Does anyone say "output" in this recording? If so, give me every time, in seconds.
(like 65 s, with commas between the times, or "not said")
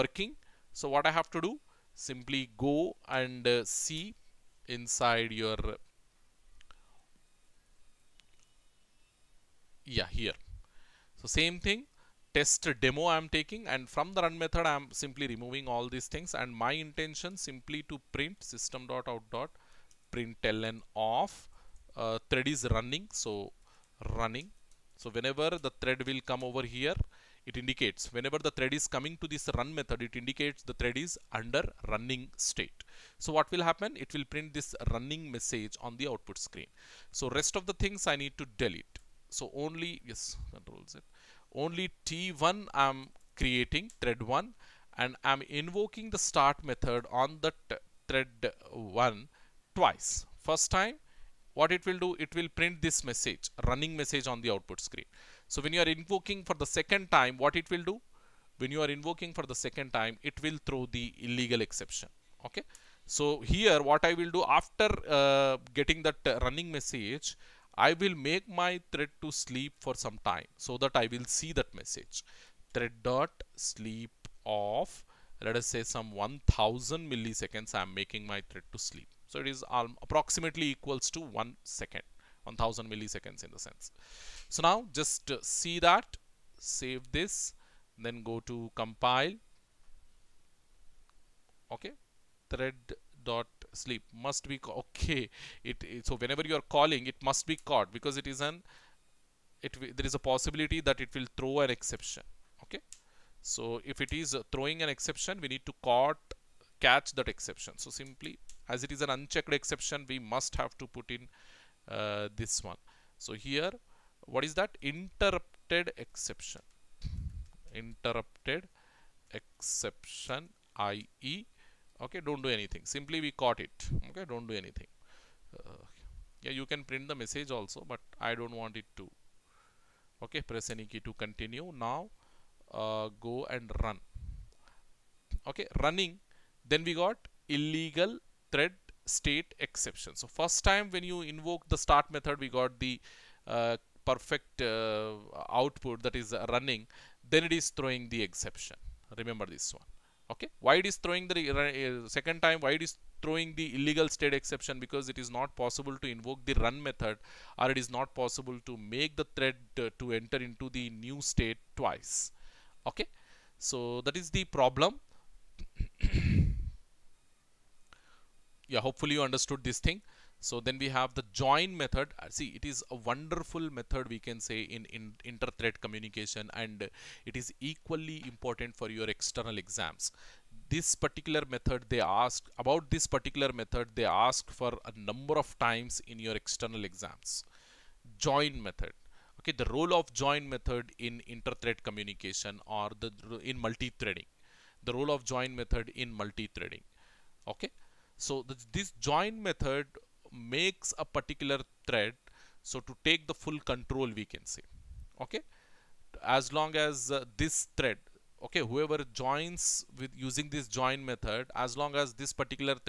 36 s, 54 s, 145 s.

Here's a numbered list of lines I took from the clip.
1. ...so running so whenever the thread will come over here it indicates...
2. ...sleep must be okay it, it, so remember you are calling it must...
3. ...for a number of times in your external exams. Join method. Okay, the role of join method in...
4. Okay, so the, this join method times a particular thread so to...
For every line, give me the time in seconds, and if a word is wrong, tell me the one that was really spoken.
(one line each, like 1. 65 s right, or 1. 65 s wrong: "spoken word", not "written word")
1. 23 s right
2. 93 s wrong: "whenever", not "remember"
3. 184 s right
4. 197 s wrong: "makes", not "times".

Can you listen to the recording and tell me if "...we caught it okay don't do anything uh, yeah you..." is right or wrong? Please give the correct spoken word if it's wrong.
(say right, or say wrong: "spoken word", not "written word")
right.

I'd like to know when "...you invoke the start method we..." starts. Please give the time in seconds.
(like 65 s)
141 s.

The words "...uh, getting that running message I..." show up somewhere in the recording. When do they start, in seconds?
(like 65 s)
65 s.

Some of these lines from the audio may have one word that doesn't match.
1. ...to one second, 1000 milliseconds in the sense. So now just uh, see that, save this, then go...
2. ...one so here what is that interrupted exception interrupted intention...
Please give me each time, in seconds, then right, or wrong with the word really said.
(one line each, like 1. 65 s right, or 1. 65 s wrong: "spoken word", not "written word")
1. 81 s right
2. 112 s wrong: "exception", not "intention".